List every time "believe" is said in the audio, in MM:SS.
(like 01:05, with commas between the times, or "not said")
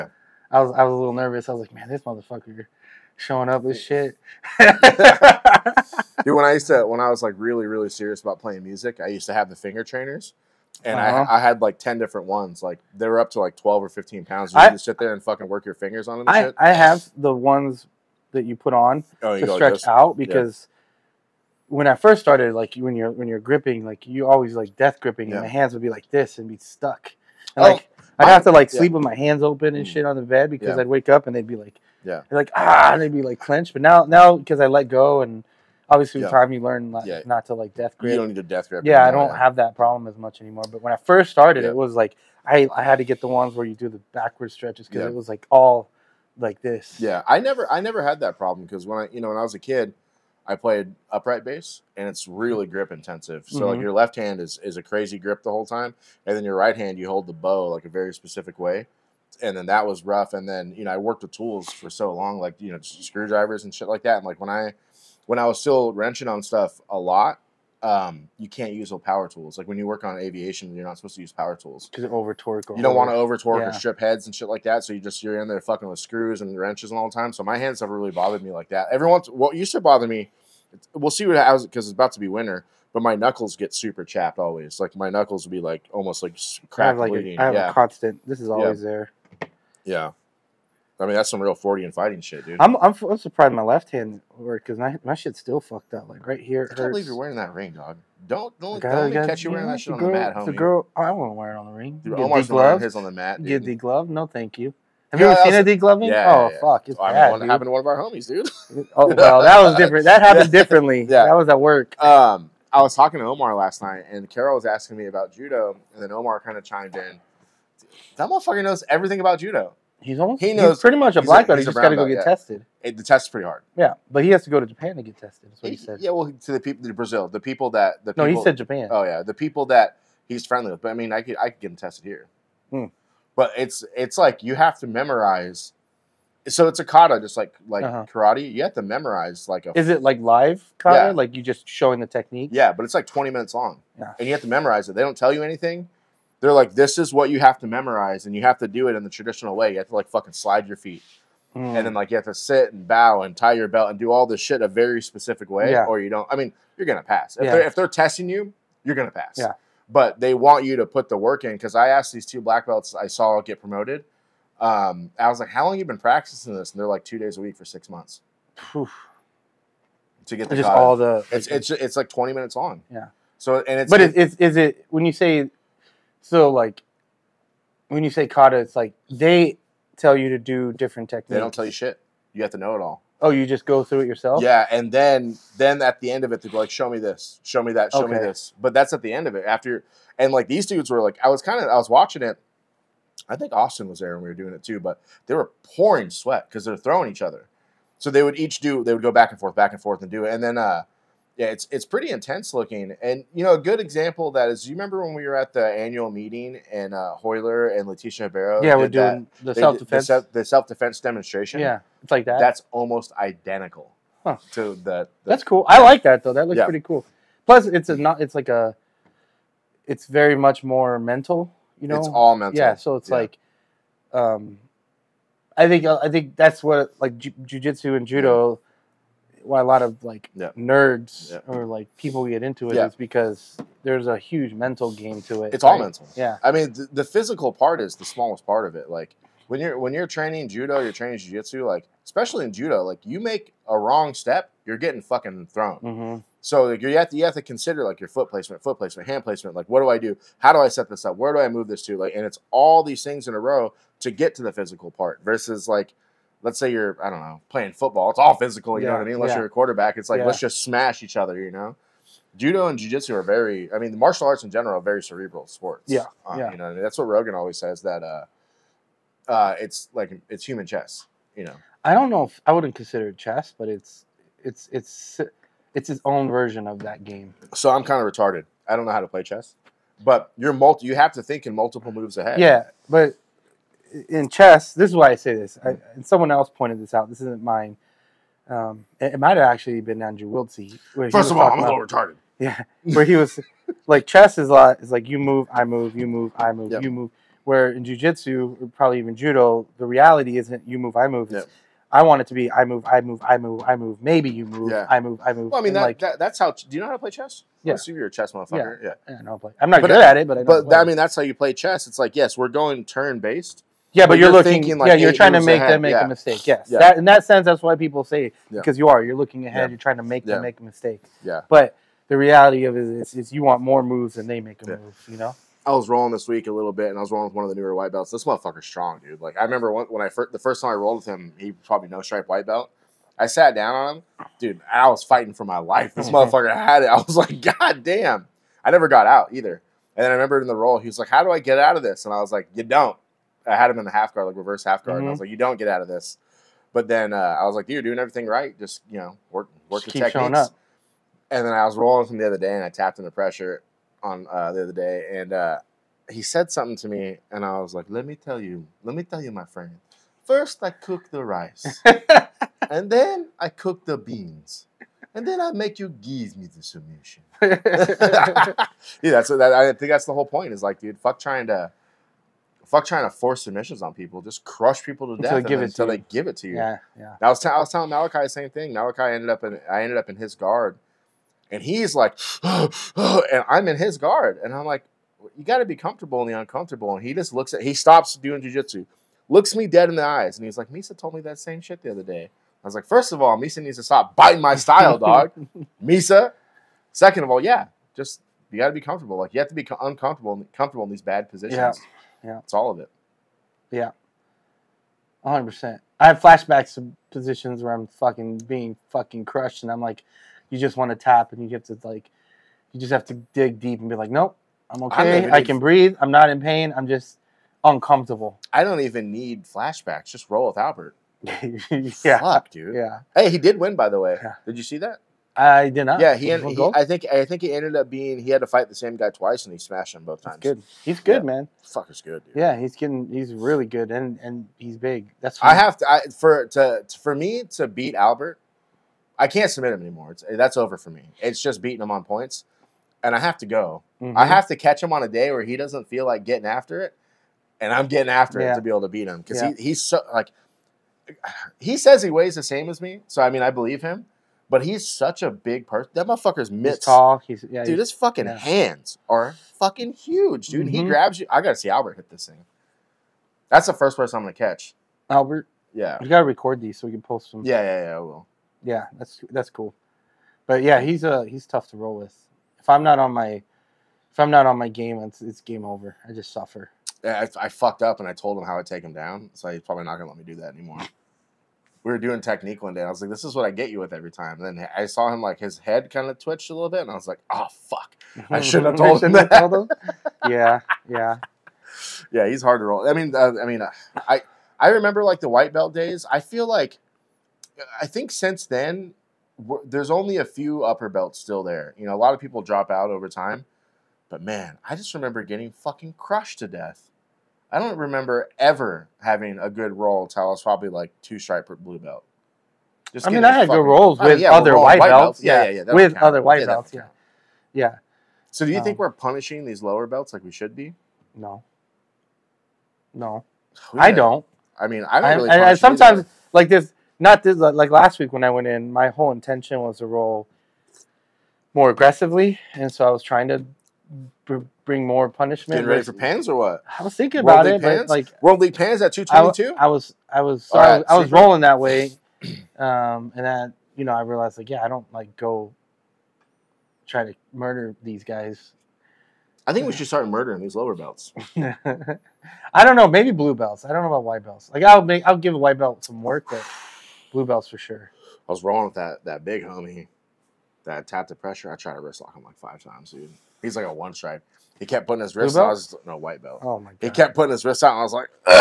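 01:36, 07:33.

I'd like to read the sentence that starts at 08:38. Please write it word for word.
So do you um, think we're punishing these lower belts like we should be?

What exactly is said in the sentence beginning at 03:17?
So they would each do they would go back and forth, back and forth, and do it.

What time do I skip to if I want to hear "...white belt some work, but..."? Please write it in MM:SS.
09:15.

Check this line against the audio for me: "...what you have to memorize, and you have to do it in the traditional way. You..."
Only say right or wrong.
right.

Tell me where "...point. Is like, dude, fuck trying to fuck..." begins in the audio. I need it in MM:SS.
06:10.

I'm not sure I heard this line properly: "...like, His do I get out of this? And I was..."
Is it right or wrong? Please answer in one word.
wrong.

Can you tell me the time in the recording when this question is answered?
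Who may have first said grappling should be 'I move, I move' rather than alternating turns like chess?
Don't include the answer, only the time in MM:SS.
04:50.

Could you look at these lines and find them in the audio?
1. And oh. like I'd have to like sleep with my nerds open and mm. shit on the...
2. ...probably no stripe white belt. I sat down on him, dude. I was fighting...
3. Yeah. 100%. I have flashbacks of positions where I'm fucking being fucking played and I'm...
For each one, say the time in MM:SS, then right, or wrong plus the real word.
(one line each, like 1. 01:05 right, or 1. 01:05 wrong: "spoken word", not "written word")
1. 00:27 wrong: "hands", not "nerds"
2. 05:31 right
3. 06:43 wrong: "crushed", not "played".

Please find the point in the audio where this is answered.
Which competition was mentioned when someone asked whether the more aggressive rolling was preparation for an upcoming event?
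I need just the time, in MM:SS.
08:58.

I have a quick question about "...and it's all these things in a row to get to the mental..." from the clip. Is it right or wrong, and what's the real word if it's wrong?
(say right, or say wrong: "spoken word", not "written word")
wrong: "physical", not "mental".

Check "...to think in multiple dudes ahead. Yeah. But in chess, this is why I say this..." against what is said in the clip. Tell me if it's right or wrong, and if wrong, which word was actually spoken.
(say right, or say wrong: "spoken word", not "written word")
wrong: "moves", not "dudes".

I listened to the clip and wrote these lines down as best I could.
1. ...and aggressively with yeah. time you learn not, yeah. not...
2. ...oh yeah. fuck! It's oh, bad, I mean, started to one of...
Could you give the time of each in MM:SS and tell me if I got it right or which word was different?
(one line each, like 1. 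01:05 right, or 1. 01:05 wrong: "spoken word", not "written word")
1. 00:35 wrong: "obviously", not "aggressively"
2. 01:46 wrong: "happened", not "started".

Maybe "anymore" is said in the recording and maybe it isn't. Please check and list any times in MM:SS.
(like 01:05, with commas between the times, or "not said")
00:40, 07:19, 08:00.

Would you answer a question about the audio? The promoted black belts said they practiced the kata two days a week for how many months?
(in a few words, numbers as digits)
6.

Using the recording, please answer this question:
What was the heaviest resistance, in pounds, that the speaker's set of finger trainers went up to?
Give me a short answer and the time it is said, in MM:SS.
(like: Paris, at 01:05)
15, at 00:13.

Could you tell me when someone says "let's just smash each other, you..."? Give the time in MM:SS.
04:20.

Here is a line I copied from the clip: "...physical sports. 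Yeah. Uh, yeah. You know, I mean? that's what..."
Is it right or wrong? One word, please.
wrong.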